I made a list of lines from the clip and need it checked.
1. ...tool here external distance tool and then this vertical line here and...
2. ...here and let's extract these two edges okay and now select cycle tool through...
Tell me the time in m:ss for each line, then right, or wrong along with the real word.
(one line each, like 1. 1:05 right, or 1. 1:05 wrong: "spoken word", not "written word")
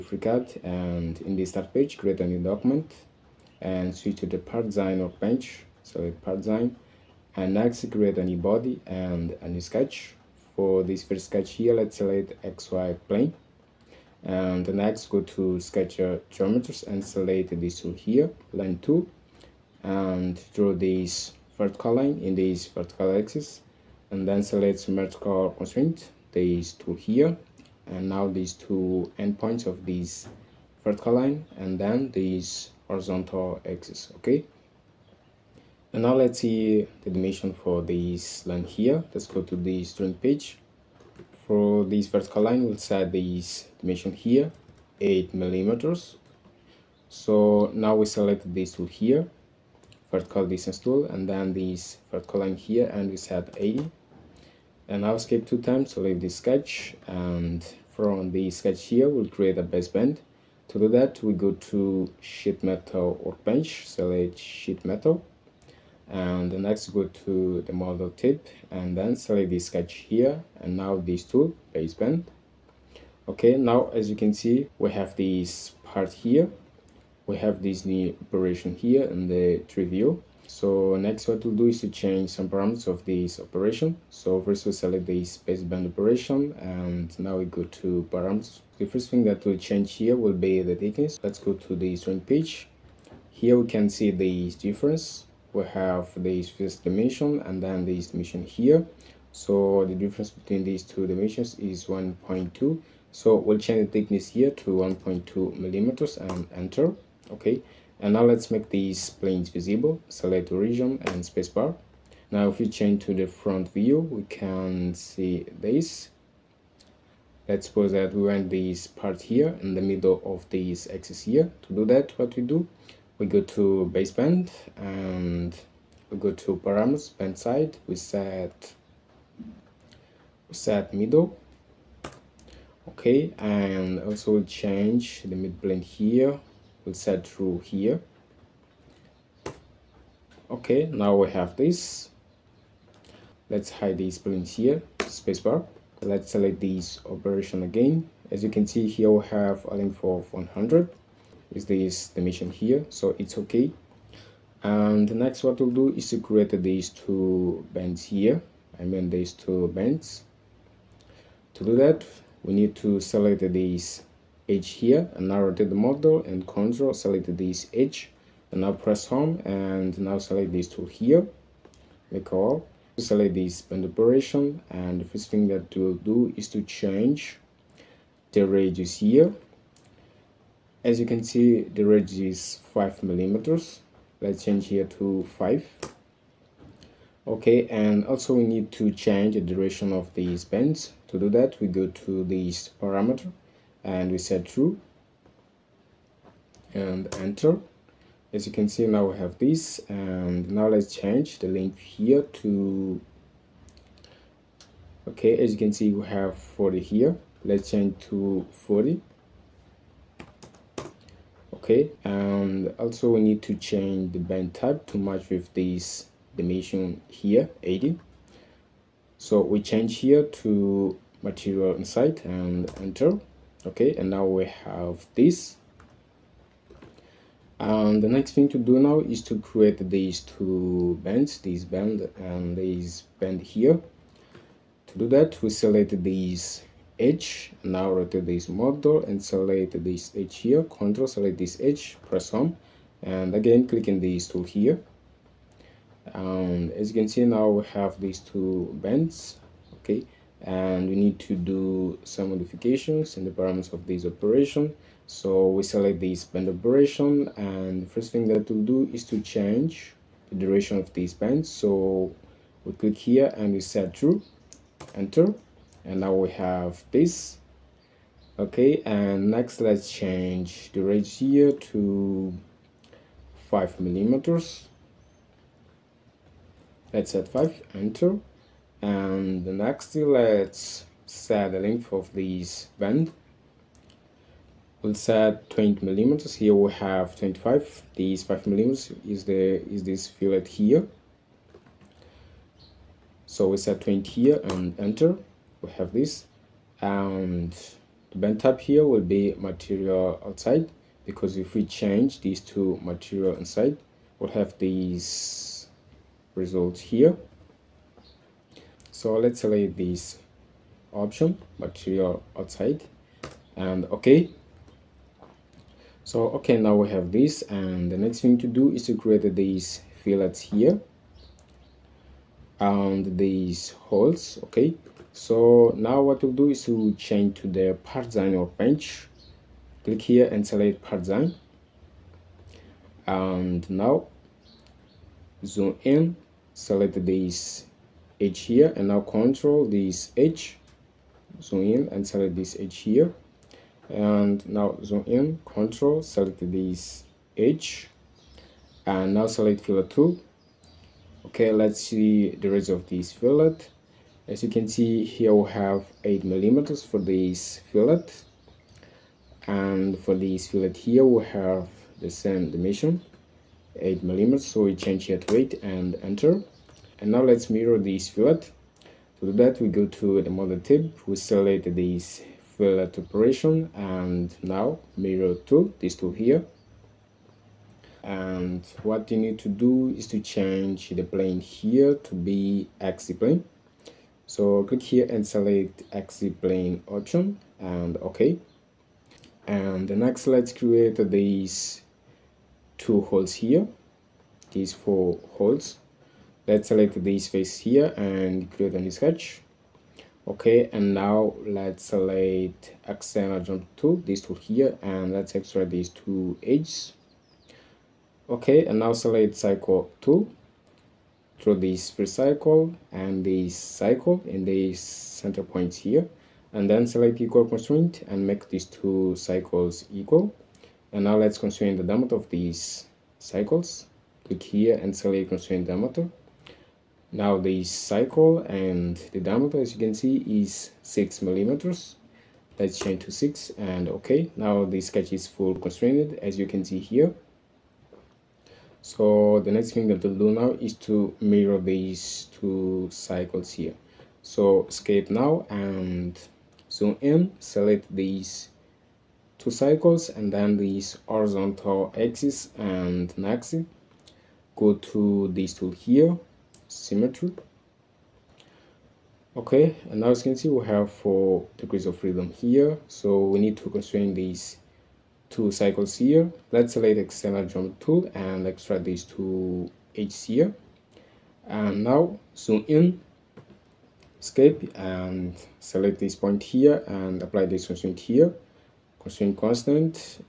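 1. 0:48 wrong: "vertical", not "external"
2. 6:44 right.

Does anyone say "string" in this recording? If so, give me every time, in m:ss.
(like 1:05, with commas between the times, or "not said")
0:39, 1:31.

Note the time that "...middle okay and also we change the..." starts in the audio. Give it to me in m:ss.
2:10.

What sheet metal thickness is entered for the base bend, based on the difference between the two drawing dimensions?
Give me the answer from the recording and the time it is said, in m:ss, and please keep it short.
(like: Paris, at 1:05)
1.2 millimeters, at 1:44.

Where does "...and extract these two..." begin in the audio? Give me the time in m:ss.
7:48.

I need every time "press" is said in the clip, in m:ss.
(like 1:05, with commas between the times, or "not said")
2:48, 4:02.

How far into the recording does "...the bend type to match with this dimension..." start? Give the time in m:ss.
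3:34.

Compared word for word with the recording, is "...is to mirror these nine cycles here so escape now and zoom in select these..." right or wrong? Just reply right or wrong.
wrong.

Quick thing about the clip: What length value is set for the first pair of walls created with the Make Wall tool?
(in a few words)
40.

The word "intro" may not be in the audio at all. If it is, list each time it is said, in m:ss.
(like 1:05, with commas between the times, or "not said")
not said.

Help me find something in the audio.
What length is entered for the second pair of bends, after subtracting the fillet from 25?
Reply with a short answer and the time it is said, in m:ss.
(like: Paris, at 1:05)
20 millimeters, at 4:45.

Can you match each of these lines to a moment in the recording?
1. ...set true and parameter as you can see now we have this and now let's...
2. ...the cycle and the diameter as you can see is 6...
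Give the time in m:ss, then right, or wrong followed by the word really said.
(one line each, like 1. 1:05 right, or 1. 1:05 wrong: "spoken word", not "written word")
1. 3:14 wrong: "enter", not "parameter"
2. 7:07 right.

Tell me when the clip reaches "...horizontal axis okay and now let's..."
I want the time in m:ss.
0:32.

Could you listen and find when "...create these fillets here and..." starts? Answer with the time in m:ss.
5:18.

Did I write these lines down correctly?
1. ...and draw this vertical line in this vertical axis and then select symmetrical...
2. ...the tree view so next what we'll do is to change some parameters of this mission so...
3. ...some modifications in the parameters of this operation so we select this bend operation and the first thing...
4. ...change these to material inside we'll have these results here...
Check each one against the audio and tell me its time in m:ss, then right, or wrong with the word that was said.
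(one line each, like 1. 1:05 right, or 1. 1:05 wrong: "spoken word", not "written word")
1. 0:19 right
2. 1:19 wrong: "operation", not "mission"
3. 4:12 right
4. 5:01 right.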